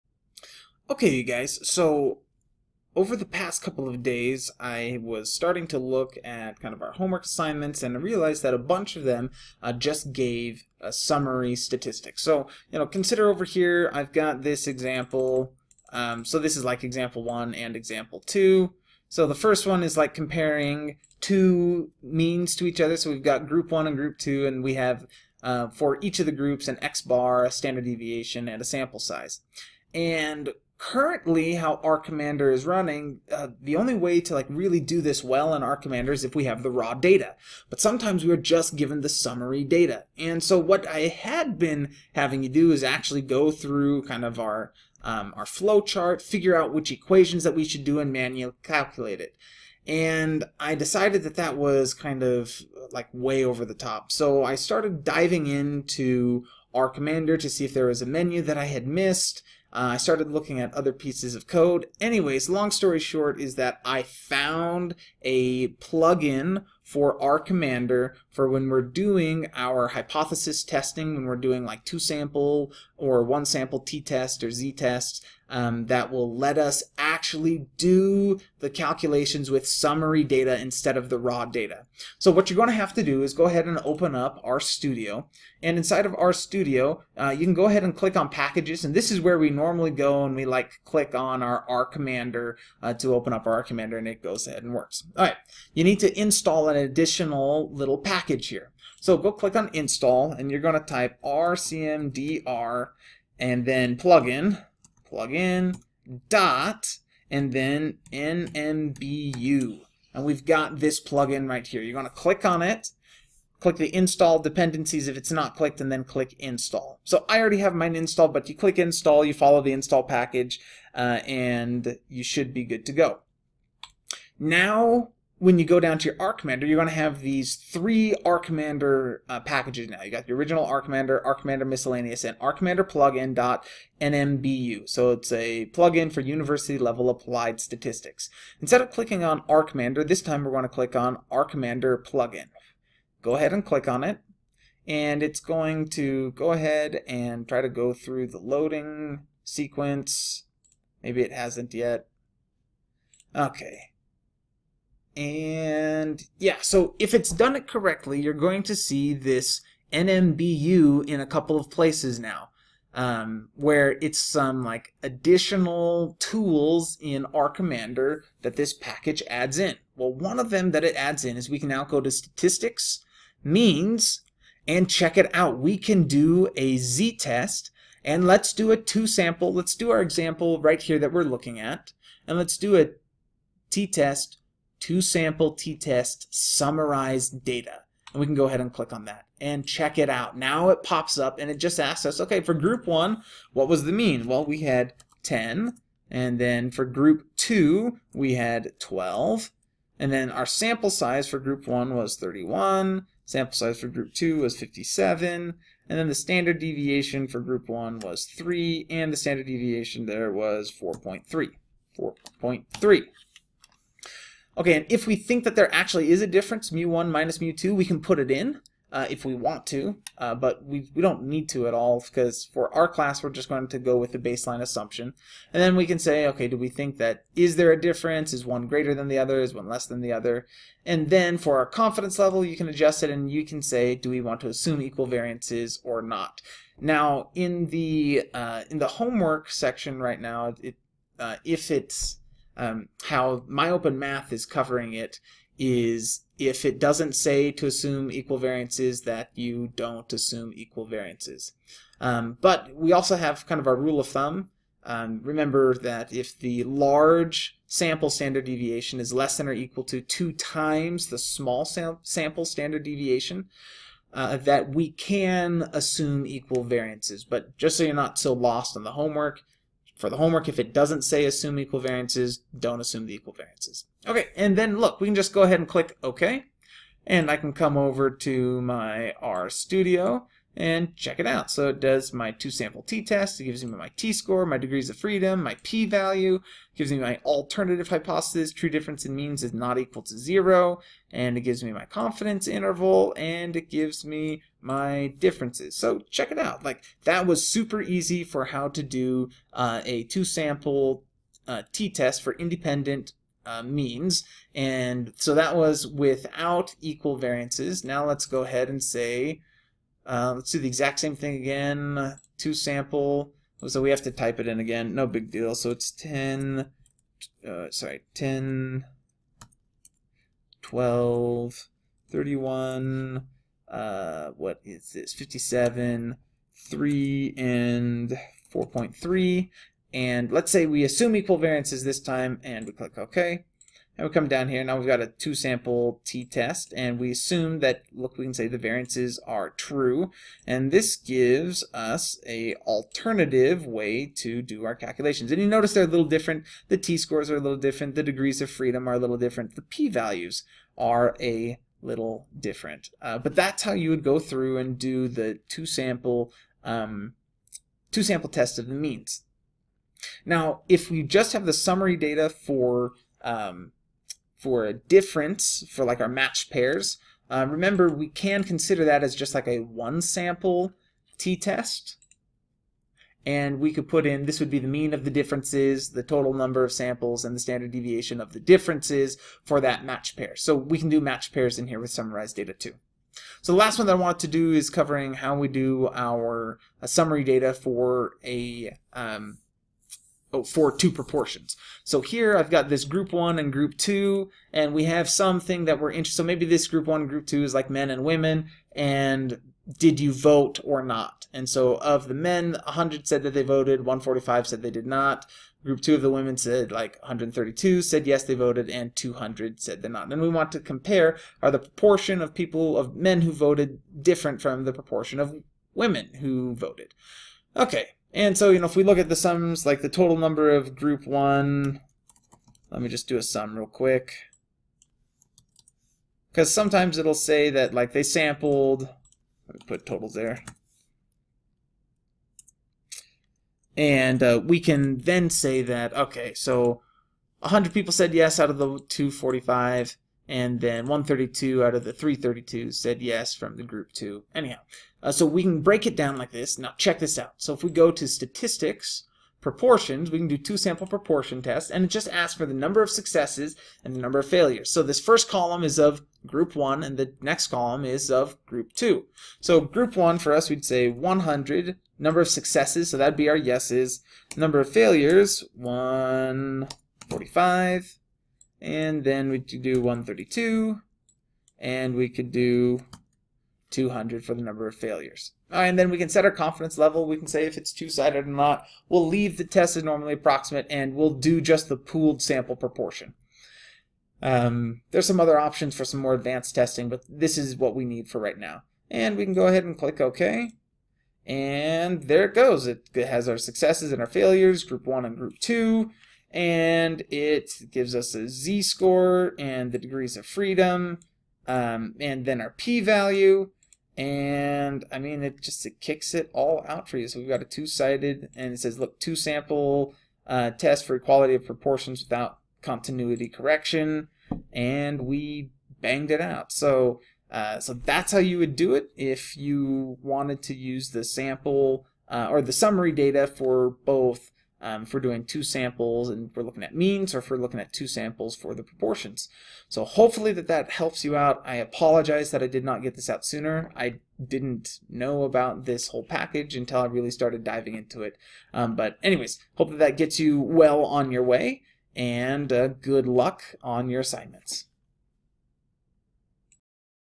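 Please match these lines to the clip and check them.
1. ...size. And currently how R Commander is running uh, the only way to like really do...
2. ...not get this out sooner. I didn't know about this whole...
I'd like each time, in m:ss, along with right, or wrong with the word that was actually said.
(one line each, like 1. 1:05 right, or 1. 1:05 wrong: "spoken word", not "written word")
1. 0:28 right
2. 8:52 right.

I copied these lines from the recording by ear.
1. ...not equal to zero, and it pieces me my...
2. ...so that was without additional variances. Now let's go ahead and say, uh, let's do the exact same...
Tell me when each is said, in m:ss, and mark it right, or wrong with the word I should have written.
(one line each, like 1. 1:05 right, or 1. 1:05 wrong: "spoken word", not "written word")
1. 4:49 wrong: "gives", not "pieces"
2. 5:05 wrong: "equal", not "additional".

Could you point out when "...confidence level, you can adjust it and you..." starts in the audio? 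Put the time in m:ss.
3:51.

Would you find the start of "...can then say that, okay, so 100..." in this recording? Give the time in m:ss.
7:14.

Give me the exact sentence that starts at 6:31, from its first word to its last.
So here I've got this group one and group two, and we have something that we're interested.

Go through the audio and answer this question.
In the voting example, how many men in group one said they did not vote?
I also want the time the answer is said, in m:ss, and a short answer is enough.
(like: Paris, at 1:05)
145, at 6:43.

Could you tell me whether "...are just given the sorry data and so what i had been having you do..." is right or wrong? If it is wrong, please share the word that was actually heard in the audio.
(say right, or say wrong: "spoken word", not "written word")
wrong: "summary", not "sorry".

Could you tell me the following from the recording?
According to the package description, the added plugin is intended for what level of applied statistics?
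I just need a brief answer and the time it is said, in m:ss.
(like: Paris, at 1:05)
university level, at 2:16.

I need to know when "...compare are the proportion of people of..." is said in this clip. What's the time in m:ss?
6:50.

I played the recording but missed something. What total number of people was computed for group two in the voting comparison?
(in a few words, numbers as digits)
332.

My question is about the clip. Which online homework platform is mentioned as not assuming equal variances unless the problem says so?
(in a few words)
MyOpenMath.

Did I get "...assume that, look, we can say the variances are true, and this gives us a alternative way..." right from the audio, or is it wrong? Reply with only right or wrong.
right.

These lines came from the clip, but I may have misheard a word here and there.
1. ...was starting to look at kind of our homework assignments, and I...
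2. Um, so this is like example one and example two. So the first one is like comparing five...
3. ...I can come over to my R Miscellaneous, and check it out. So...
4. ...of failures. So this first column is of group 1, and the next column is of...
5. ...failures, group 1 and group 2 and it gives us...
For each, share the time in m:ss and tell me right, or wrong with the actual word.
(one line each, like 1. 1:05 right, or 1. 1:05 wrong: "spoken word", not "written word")
1. 0:05 right
2. 0:15 wrong: "two", not "five"
3. 4:37 wrong: "Studio", not "Miscellaneous"
4. 7:34 right
5. 8:14 right.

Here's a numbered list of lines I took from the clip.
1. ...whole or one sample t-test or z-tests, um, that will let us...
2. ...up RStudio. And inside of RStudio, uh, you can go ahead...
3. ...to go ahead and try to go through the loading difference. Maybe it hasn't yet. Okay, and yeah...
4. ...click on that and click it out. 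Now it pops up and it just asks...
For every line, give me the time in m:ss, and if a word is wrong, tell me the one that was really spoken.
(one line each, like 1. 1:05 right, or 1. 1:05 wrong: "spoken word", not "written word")
1. 1:11 wrong: "sample", not "whole"
2. 1:24 right
3. 2:25 wrong: "sequence", not "difference"
4. 3:08 wrong: "check", not "click".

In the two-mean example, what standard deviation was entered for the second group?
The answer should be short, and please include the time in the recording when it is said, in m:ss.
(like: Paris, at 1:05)
4.3, at 3:28.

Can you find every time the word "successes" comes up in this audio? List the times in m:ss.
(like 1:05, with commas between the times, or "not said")
7:32, 7:42, 8:13.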